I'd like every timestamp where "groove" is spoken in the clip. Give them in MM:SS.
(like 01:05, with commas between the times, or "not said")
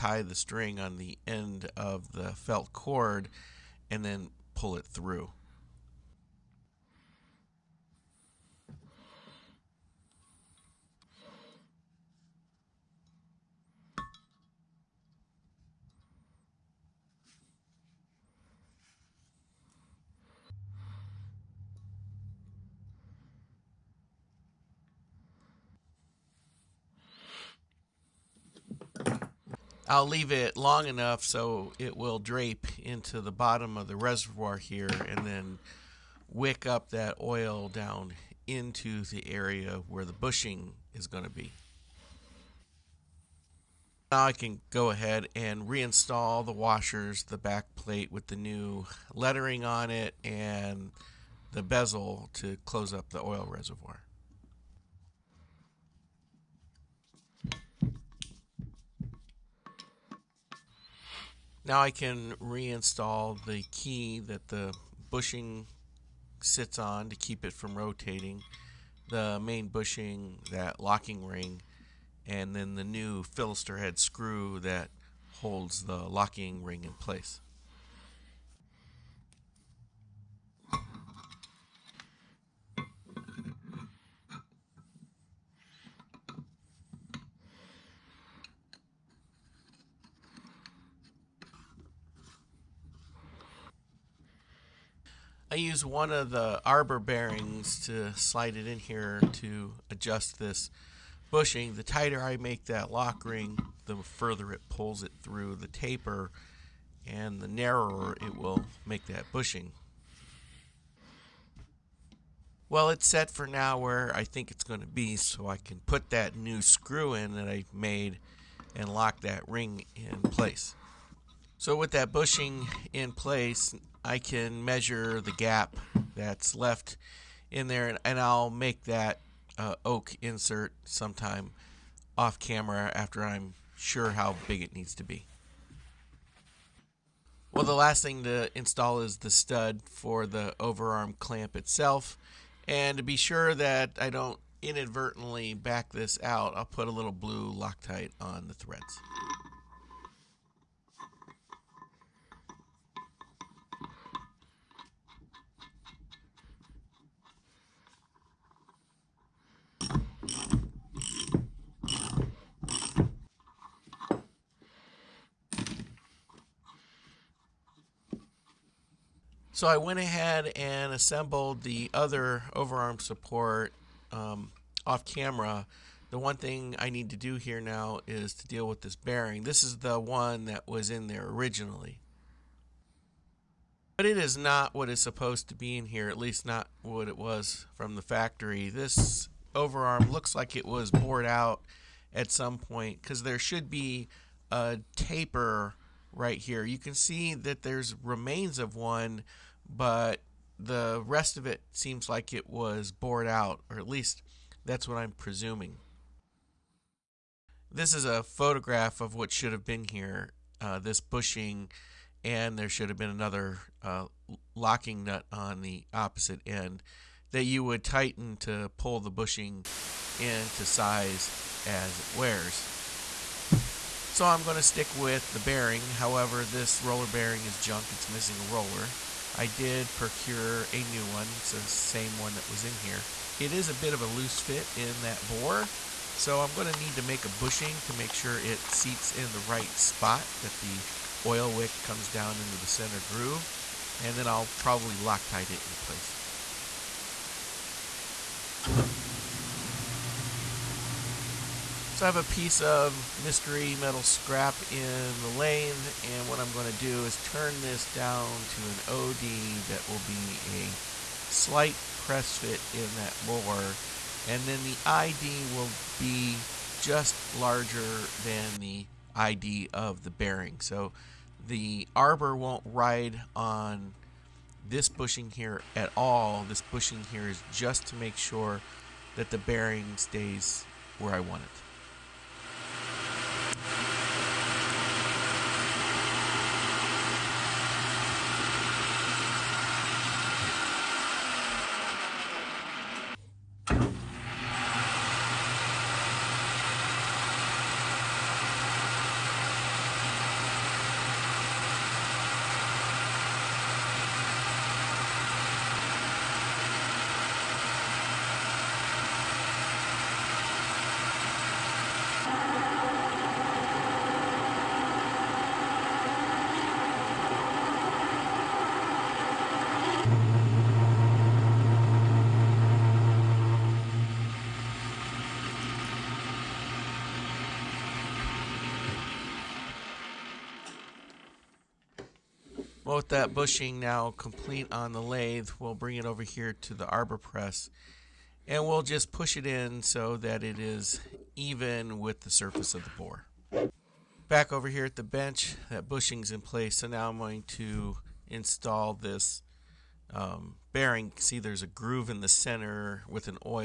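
04:03, 05:51.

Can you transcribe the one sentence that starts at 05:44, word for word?
Back over here at the bench, that bushing's in place.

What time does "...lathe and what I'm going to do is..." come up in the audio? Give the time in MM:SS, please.
04:15.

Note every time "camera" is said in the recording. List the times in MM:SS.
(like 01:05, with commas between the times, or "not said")
02:12, 02:55.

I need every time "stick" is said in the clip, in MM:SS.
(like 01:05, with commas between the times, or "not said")
03:44.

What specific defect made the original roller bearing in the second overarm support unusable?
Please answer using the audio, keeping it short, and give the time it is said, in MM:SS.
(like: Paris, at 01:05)
missing a roller, at 03:48.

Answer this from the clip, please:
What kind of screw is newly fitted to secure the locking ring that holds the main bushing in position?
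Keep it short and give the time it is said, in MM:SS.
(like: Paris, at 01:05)
fillister head screw, at 01:13.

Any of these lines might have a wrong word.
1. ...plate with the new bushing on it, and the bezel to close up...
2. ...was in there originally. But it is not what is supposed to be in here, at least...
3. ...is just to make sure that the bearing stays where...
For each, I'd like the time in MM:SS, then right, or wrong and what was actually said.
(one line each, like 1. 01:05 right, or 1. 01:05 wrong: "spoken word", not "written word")
1. 00:47 wrong: "lettering", not "bushing"
2. 03:00 right
3. 04:37 right.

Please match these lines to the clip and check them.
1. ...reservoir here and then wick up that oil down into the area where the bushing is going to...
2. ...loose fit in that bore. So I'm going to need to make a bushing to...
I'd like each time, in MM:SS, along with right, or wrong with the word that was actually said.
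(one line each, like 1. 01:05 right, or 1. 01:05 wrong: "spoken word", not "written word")
1. 00:33 right
2. 03:54 right.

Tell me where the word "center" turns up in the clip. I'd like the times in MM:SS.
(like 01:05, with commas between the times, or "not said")
04:02, 05:52.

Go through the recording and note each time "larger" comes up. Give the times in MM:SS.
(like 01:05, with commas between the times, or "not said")
04:27.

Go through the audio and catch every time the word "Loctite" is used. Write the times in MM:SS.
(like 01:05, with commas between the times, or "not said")
02:27, 04:04.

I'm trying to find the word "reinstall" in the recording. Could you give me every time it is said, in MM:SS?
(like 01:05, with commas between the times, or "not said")
00:45, 01:02.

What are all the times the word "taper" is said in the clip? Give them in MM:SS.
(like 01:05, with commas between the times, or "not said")
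01:45, 03:14.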